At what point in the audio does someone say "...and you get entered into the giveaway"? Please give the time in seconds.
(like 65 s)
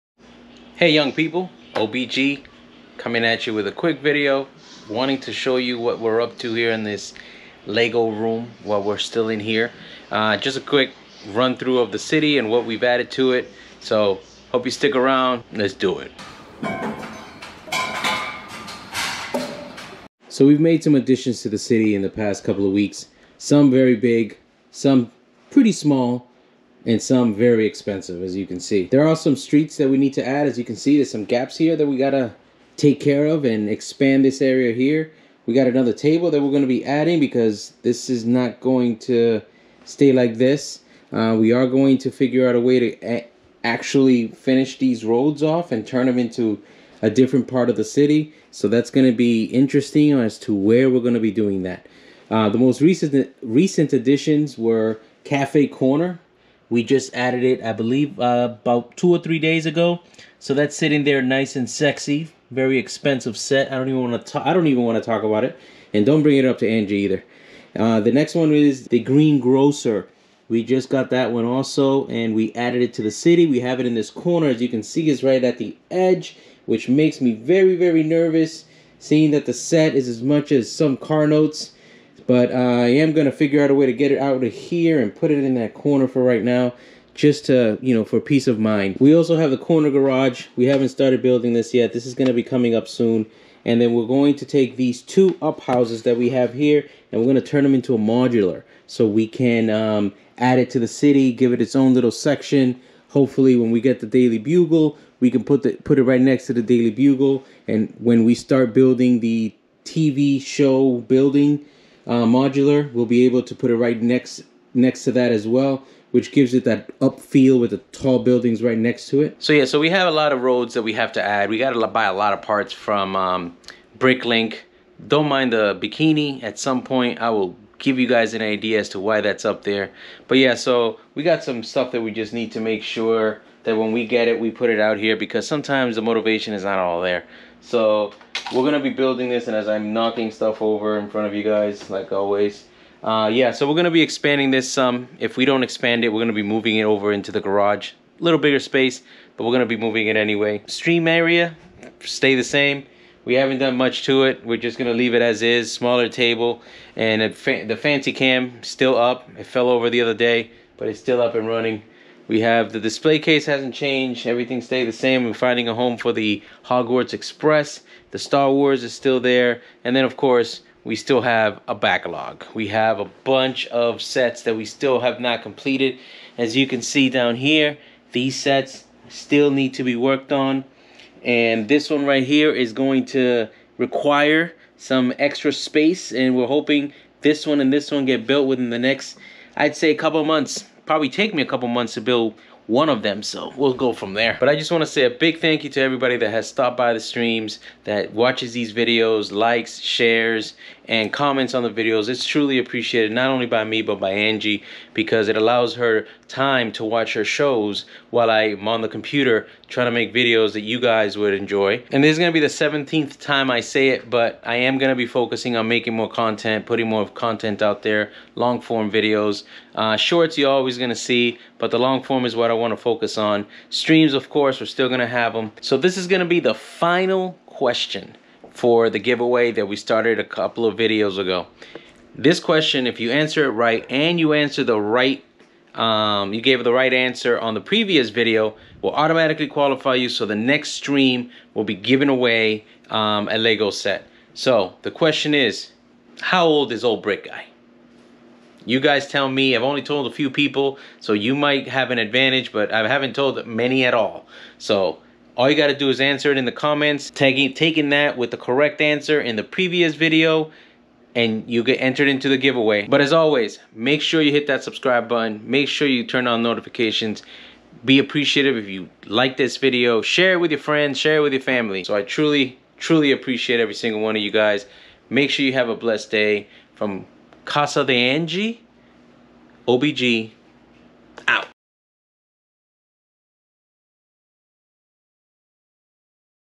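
261 s.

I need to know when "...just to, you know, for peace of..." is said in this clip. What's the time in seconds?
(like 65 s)
87 s.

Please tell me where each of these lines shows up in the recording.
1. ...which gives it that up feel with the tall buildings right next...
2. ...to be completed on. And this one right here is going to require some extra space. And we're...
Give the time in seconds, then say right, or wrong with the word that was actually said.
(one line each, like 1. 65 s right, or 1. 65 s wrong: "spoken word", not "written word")
1. 116 s right
2. 179 s wrong: "worked", not "completed".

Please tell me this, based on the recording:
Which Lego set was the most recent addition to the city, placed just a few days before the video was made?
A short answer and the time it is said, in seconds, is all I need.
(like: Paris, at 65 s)
Cafe Corner, at 55 s.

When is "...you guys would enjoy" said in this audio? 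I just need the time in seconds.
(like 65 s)
210 s.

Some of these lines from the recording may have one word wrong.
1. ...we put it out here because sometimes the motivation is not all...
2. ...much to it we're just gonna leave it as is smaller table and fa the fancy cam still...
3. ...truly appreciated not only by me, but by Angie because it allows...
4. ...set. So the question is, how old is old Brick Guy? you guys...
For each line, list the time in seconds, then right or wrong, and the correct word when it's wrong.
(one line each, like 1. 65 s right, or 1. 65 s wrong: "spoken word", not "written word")
1. 134 s right
2. 153 s right
3. 202 s right
4. 243 s right.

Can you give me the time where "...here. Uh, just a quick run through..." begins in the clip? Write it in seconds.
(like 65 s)
9 s.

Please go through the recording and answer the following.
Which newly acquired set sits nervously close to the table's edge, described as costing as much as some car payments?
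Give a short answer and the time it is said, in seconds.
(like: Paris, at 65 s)
Green Grocer, at 69 s.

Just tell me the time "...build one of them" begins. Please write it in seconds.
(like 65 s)
192 s.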